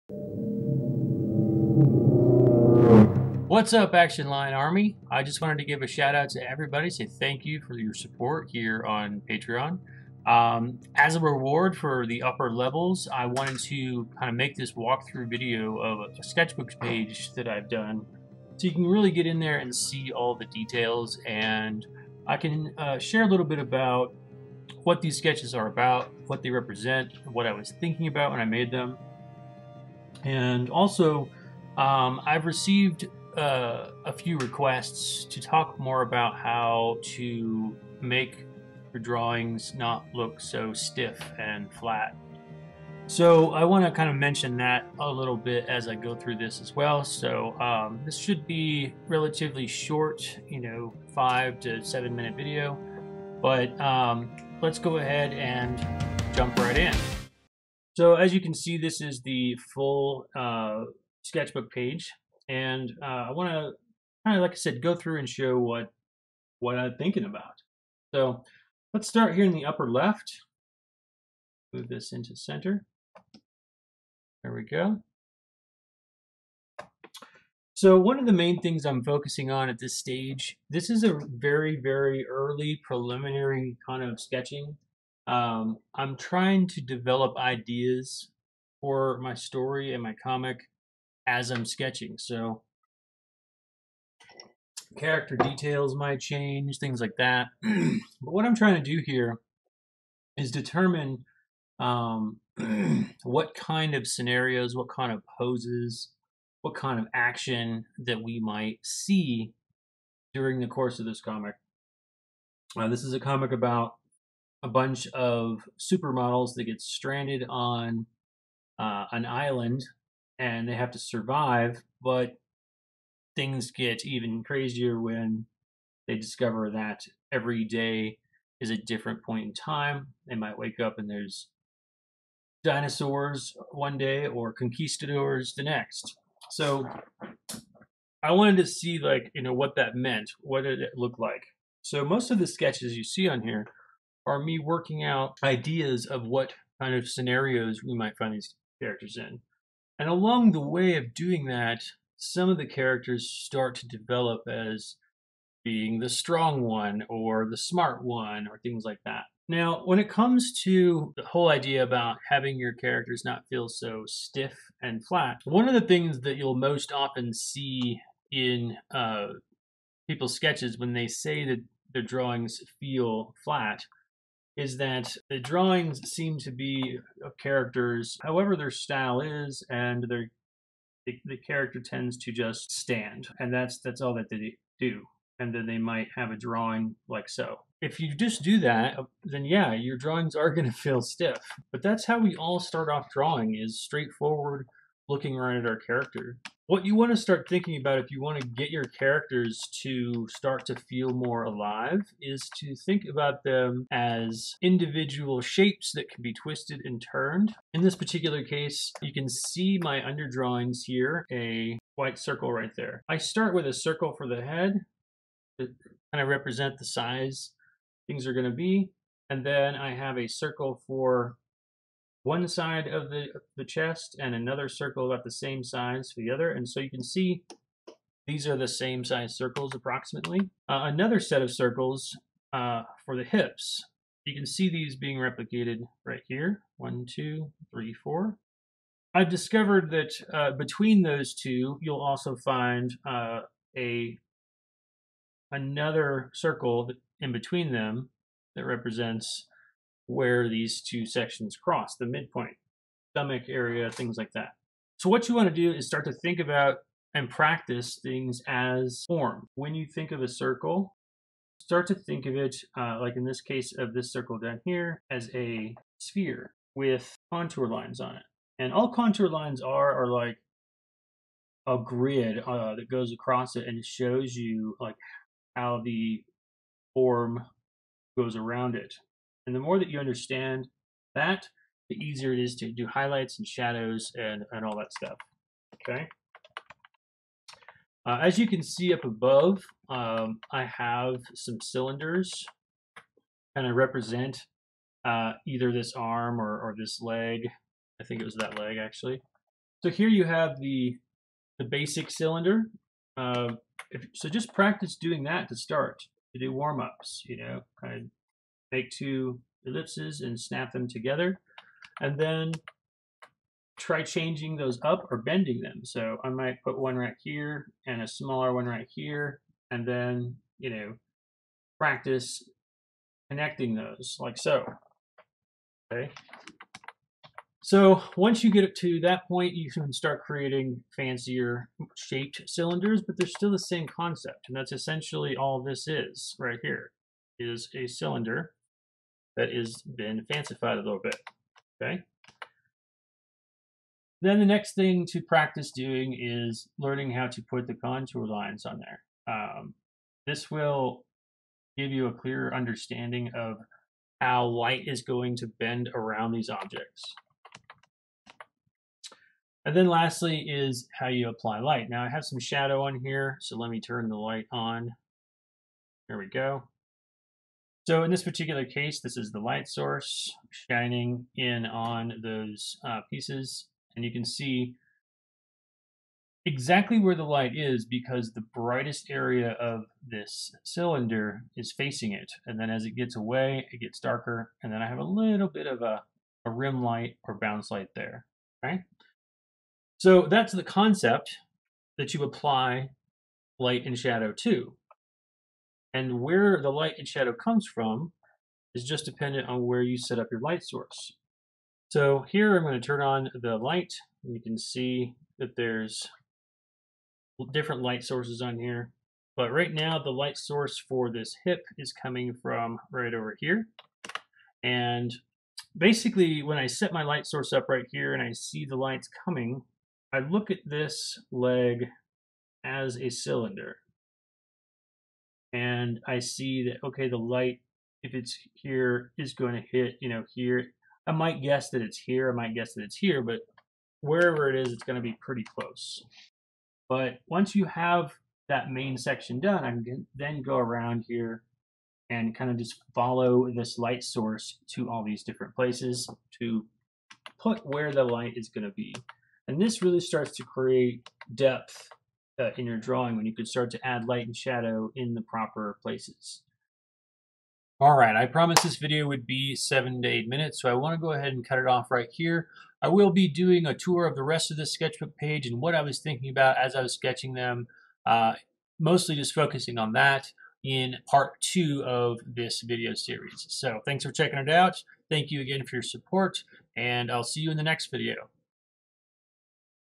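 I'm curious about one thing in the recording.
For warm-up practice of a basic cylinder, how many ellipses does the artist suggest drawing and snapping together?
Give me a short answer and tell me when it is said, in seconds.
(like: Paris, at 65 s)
2, at 308 s.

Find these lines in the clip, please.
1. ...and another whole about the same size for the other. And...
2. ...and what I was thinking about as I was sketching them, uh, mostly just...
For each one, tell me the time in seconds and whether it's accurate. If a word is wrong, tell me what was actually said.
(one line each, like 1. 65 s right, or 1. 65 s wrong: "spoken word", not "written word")
1. 224 s wrong: "circle", not "whole"
2. 465 s right.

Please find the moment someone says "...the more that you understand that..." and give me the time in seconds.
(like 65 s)
279 s.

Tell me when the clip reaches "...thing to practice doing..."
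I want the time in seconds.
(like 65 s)
344 s.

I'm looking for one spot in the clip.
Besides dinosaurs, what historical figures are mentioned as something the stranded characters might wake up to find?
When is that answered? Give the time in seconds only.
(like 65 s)
134 s.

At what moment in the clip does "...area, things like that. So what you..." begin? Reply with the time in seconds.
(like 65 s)
253 s.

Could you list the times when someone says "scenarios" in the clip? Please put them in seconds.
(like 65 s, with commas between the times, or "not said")
104 s, 147 s.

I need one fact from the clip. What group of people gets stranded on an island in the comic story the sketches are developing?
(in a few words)
supermodels.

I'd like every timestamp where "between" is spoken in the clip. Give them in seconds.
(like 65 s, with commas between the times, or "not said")
240 s, 247 s.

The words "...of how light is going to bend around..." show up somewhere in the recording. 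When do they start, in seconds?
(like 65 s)
353 s.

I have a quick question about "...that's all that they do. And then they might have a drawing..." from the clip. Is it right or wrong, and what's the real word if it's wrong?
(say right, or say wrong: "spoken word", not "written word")
right.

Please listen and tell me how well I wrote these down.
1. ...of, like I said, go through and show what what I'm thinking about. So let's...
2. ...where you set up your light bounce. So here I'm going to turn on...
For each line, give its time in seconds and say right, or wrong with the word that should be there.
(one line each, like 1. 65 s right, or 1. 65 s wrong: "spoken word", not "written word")
1. 64 s right
2. 399 s wrong: "source", not "bounce".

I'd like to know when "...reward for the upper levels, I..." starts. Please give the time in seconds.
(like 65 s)
11 s.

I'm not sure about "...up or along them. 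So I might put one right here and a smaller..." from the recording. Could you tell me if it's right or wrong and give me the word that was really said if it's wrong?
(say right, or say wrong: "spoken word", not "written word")
wrong: "bending", not "along".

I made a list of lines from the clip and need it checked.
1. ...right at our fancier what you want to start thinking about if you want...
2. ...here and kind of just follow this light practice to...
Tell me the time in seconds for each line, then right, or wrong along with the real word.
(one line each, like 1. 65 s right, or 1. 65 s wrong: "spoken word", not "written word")
1. 195 s wrong: "character", not "fancier"
2. 441 s wrong: "source", not "practice".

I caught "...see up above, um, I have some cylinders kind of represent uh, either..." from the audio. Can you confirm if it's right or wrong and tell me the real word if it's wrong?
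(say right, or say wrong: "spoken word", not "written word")
right.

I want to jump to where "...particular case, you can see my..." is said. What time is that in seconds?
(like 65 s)
207 s.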